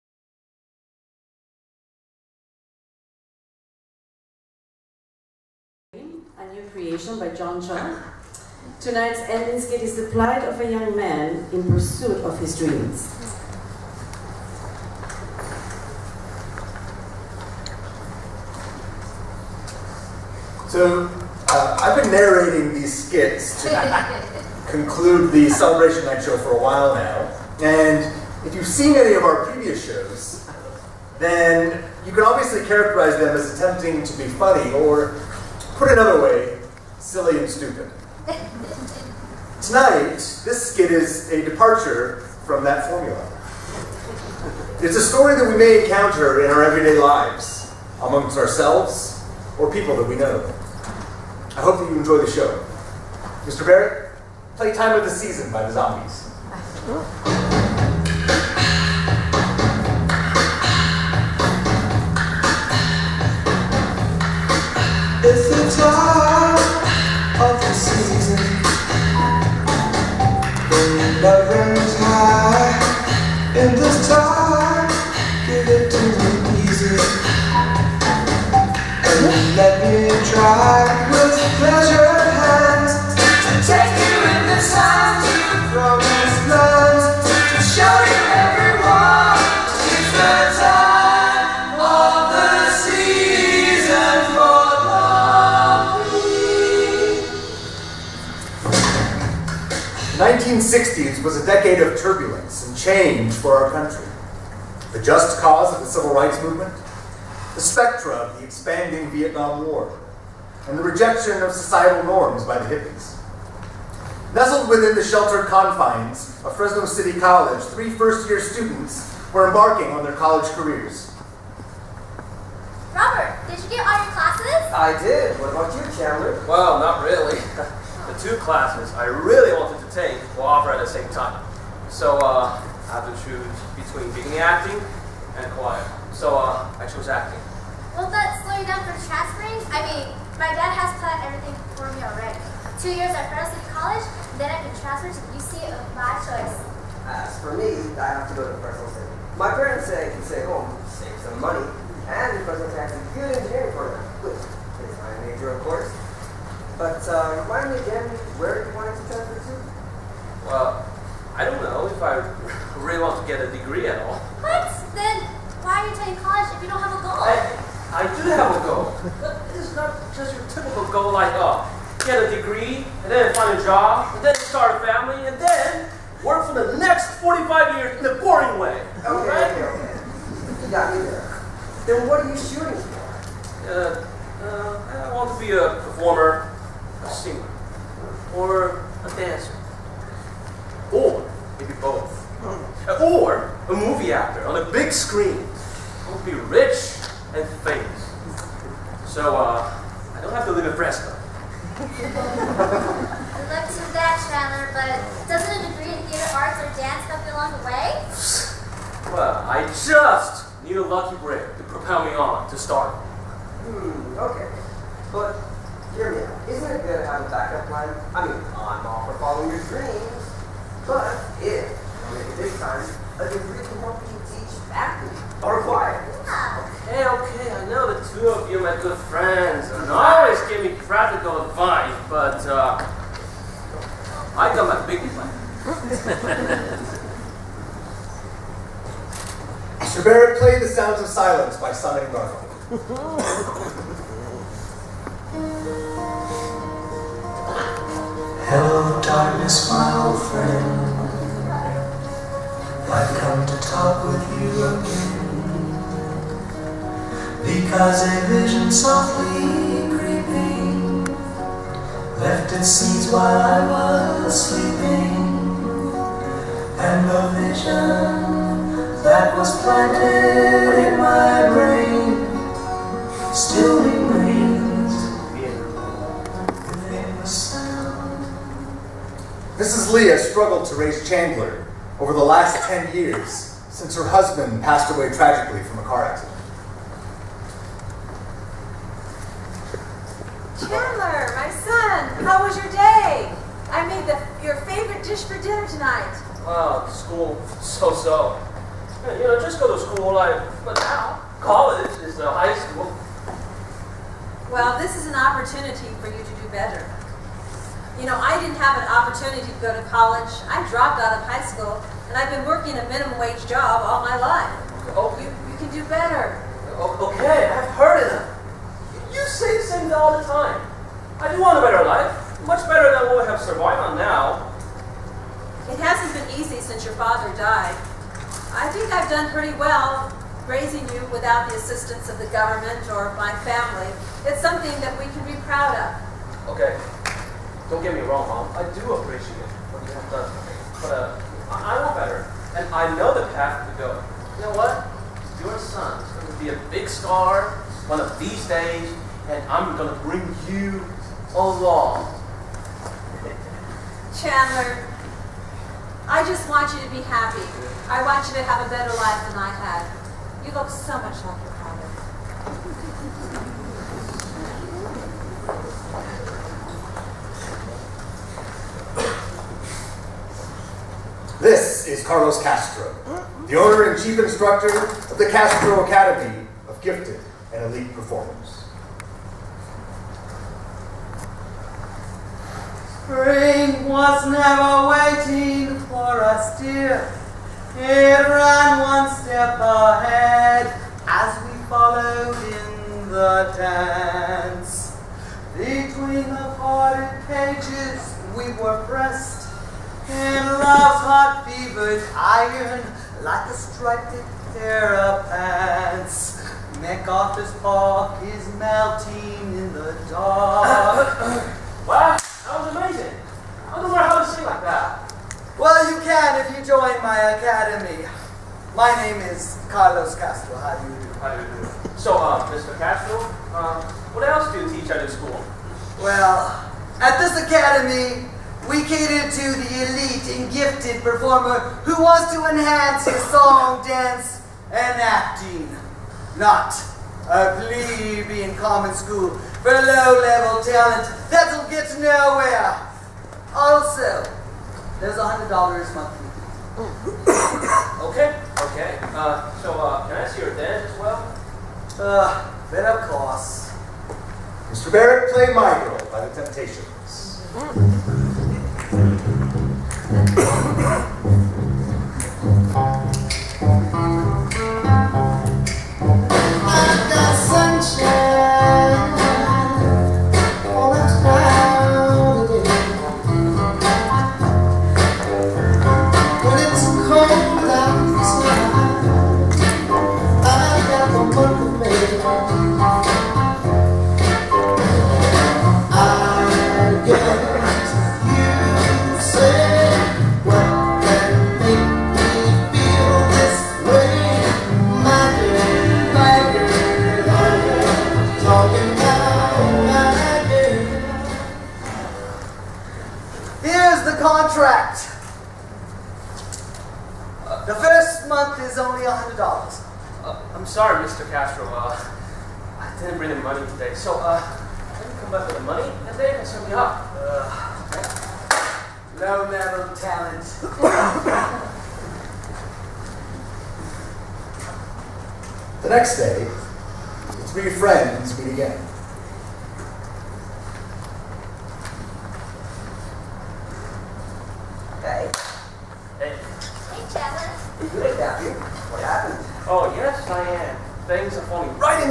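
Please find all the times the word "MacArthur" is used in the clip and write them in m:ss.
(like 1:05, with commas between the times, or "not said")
6:46.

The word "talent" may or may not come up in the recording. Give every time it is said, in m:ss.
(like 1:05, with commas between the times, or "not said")
7:20, 8:39.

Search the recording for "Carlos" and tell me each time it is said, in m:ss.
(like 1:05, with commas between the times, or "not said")
6:12, 6:59.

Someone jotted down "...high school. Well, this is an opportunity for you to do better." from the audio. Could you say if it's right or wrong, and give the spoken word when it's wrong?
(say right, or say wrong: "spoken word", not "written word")
right.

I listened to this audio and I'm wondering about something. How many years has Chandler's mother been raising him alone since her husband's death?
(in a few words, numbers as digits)
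10.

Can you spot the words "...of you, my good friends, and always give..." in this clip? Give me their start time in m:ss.
3:48.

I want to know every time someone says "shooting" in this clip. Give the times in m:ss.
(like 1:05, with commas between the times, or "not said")
3:02.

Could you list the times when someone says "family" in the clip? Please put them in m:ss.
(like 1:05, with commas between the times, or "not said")
2:54, 5:33.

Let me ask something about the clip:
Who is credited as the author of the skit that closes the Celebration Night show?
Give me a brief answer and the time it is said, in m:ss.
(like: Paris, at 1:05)
John Chung, at 0:07.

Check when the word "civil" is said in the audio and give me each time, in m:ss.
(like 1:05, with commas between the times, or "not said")
1:45.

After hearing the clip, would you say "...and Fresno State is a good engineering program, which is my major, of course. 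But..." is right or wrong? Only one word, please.
right.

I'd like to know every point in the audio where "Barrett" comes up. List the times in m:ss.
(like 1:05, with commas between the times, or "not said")
0:53, 4:00, 7:34.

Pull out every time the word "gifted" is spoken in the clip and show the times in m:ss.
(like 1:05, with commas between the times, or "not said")
6:16, 7:10.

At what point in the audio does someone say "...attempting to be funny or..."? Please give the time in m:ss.
0:33.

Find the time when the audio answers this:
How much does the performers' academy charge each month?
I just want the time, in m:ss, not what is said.
7:25.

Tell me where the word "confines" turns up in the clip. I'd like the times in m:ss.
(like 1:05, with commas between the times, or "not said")
1:55.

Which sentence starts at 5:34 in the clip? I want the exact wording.
It's something that we can be proud of.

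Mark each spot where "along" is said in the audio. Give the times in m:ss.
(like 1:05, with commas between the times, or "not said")
3:27, 5:51.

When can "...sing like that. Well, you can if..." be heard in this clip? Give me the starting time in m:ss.
6:54.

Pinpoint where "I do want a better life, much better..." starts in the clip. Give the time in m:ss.
5:21.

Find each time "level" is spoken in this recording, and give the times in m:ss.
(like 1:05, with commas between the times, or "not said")
7:19, 8:39.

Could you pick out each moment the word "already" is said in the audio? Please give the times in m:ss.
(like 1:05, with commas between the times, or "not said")
2:22.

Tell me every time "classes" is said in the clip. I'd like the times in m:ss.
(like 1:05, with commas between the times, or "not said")
2:04, 2:08.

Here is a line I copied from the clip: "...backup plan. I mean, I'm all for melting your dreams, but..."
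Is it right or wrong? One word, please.
wrong.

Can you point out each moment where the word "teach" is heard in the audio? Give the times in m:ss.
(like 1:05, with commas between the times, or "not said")
3:44, 7:04.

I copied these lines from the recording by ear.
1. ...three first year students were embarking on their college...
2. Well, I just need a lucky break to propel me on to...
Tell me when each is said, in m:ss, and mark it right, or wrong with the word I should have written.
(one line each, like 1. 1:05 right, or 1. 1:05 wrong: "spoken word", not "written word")
1. 1:57 right
2. 3:29 right.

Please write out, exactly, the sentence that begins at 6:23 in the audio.
Spring was never waiting for us, dear.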